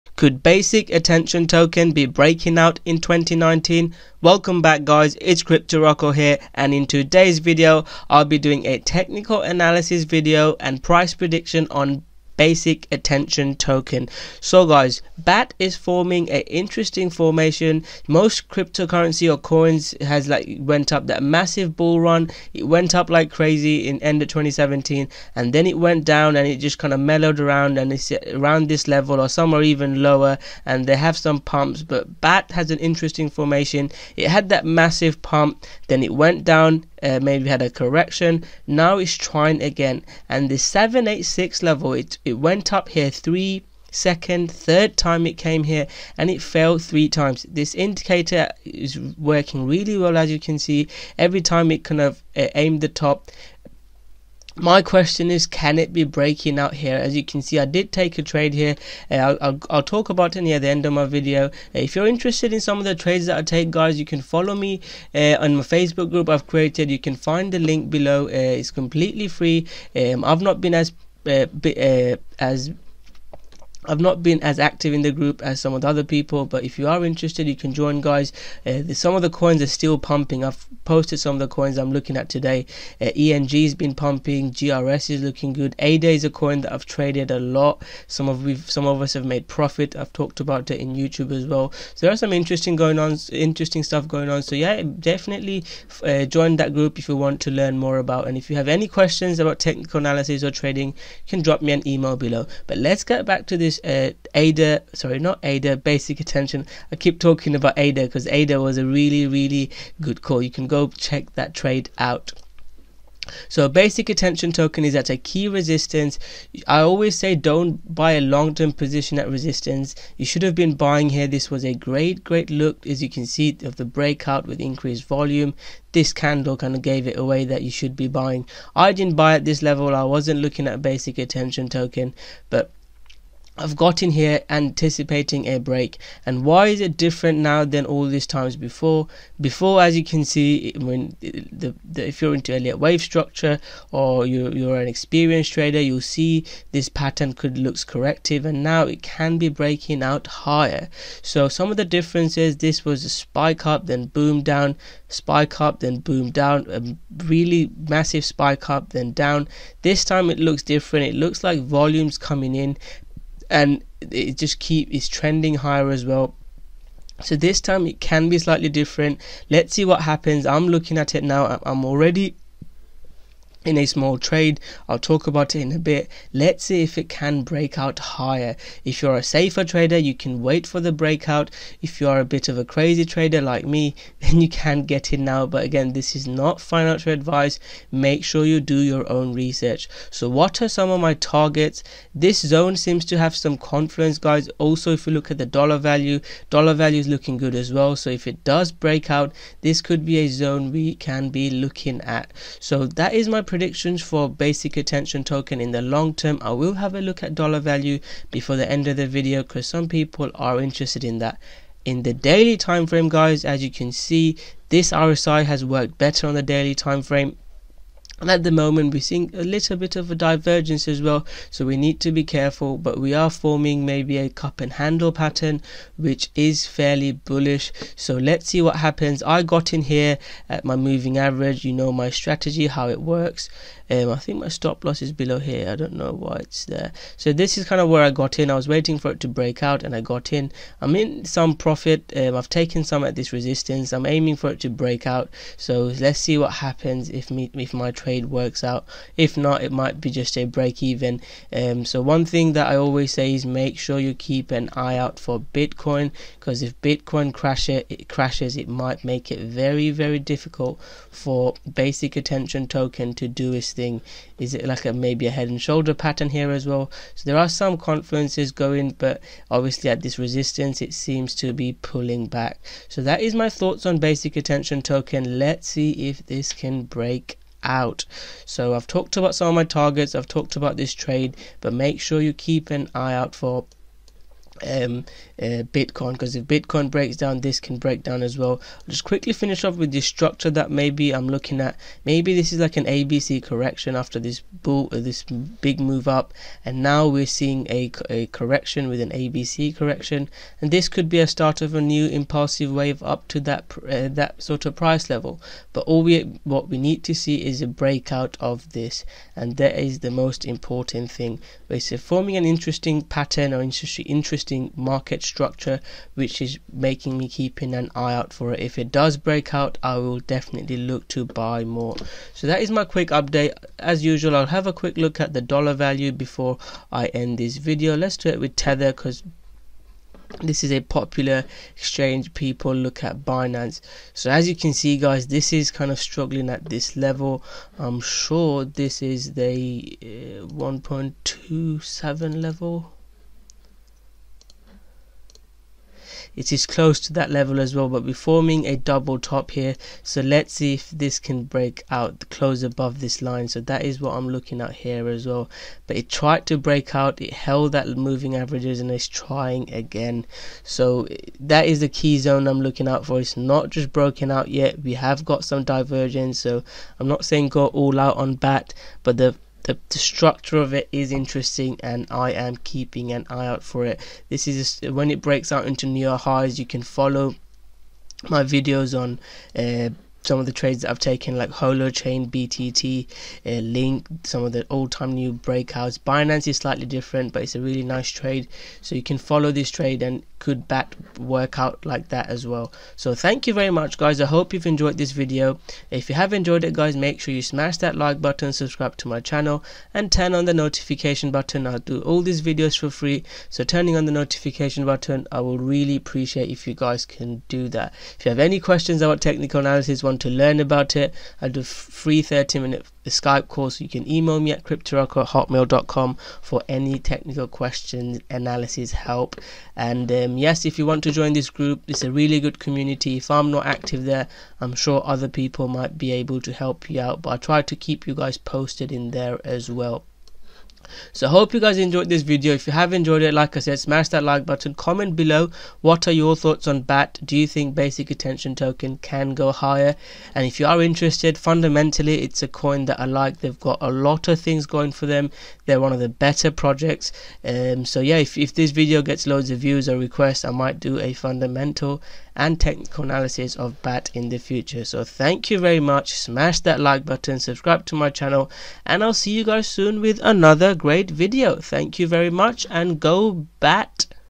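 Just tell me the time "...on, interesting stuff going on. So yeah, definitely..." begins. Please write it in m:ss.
1:32.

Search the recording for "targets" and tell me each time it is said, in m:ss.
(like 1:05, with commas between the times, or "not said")
3:11, 4:39.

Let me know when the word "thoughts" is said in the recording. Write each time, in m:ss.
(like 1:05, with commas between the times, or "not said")
4:33, 7:16.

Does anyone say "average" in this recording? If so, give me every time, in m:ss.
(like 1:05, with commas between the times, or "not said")
3:51, 5:58.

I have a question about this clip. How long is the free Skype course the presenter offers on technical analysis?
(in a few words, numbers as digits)
30 minutes.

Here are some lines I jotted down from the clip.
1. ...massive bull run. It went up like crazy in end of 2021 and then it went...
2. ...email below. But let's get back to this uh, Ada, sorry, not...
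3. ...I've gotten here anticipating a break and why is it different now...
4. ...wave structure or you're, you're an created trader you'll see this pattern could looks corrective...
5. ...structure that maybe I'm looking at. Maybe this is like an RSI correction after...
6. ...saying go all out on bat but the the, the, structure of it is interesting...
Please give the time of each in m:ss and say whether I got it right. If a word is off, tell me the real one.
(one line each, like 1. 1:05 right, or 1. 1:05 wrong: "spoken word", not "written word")
1. 0:21 wrong: "2017", not "2021"
2. 1:41 right
3. 2:13 right
4. 2:22 wrong: "experienced", not "created"
5. 4:50 wrong: "ABC", not "RSI"
6. 6:07 right.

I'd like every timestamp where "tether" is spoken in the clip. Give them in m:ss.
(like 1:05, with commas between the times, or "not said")
5:28.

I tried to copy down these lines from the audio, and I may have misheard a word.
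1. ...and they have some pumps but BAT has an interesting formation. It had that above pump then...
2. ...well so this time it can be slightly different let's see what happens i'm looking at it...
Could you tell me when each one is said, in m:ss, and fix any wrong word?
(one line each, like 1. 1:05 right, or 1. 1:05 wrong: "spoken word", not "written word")
1. 0:30 wrong: "massive", not "above"
2. 2:46 right.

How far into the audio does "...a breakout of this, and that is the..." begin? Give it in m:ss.
5:07.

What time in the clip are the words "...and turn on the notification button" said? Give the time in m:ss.
6:39.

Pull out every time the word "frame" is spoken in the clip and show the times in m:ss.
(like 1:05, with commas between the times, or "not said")
3:32, 3:37.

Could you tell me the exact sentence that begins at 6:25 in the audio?
Binance is slightly different, but it's a really nice trade.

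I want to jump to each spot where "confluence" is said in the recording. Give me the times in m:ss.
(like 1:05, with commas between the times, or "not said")
3:13, 4:27.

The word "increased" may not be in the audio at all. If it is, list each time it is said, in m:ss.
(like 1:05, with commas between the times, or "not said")
2:04.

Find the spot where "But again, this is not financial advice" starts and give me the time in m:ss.
3:05.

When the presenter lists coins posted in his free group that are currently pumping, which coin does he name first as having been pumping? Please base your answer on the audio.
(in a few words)
ENG.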